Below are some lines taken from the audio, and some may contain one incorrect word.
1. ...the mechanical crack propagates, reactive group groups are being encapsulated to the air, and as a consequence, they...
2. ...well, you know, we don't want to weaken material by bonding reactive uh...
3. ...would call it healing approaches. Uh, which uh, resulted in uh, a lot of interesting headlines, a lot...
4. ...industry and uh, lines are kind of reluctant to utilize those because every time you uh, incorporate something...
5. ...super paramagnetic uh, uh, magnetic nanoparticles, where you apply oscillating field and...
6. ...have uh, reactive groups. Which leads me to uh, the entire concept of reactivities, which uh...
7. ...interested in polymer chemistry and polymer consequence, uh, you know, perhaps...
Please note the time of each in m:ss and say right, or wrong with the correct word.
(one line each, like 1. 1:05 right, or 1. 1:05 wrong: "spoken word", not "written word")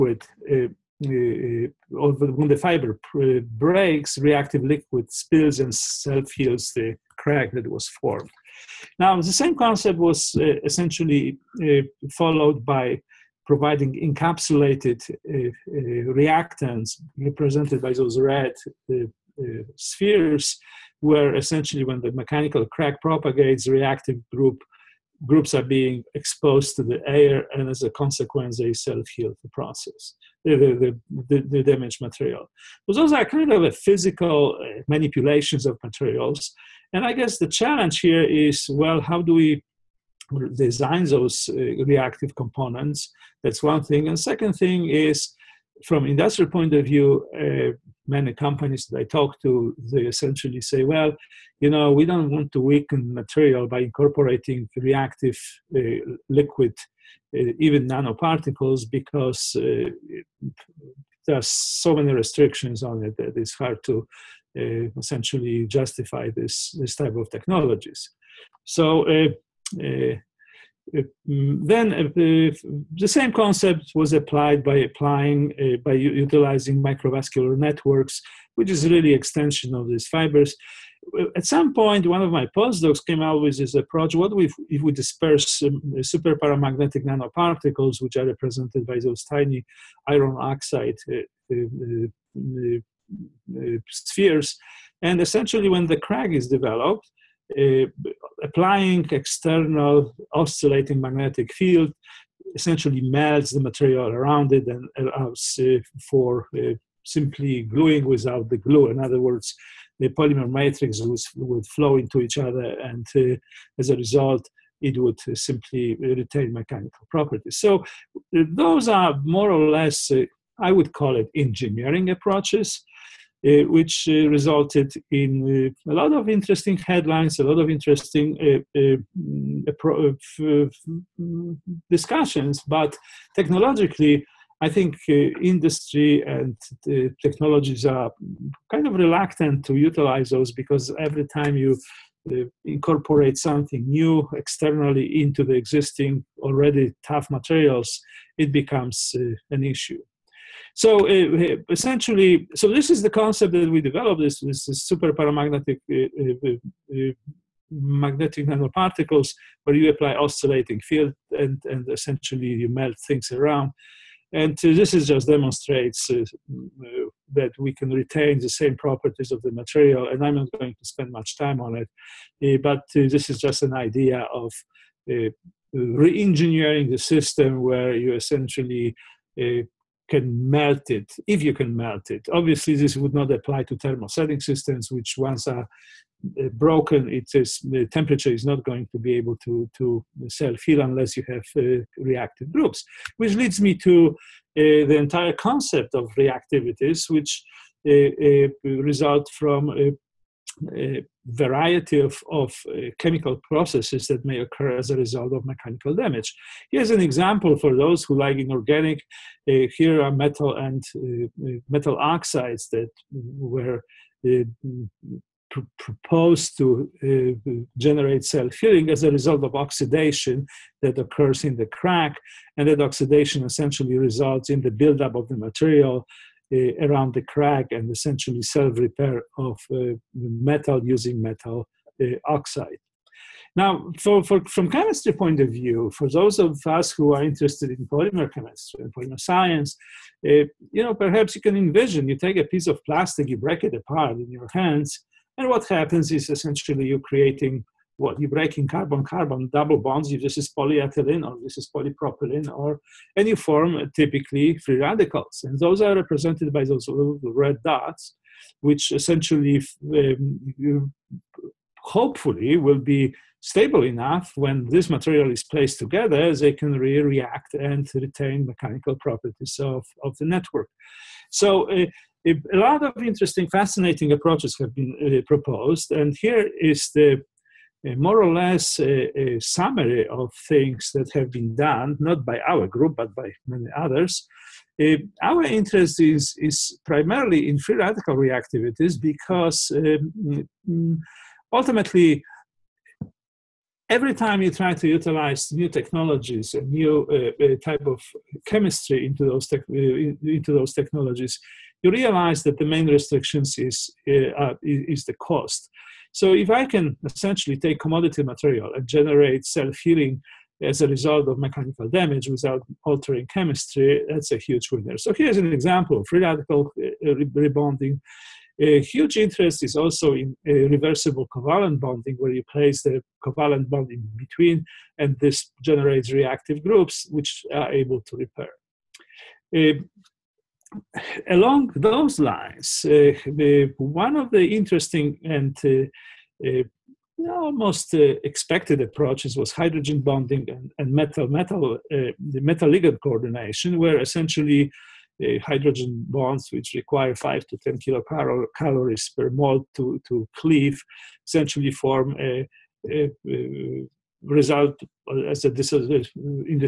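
1. 0:22 wrong: "exposed", not "encapsulated"
2. 0:50 wrong: "incorporating", not "bonding"
3. 2:00 wrong: "engineering", not "healing"
4. 2:15 wrong: "technologies", not "lines"
5. 2:34 right
6. 3:11 right
7. 3:57 wrong: "science", not "consequence".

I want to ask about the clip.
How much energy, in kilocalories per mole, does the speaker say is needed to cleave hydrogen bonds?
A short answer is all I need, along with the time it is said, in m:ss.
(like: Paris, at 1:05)
5 to 10, at 5:47.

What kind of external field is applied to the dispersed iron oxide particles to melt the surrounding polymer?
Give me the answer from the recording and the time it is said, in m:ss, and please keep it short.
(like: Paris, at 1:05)
Oscillating magnetic field, at 1:40.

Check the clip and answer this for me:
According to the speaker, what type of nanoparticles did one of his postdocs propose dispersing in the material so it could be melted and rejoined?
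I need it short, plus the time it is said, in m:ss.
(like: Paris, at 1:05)
Super paramagnetic nanoparticles, at 1:26.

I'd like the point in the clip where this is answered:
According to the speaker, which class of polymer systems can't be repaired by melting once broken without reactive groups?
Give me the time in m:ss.
3:03.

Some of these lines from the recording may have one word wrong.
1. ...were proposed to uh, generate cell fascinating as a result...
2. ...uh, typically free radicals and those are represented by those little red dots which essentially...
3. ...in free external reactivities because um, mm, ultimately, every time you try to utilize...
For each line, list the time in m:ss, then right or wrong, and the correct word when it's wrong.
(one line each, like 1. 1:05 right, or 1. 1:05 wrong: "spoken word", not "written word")
1. 3:33 wrong: "healing", not "fascinating"
2. 4:13 right
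3. 4:47 wrong: "radical", not "external".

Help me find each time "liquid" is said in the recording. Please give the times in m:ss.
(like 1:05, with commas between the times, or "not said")
0:04, 0:56.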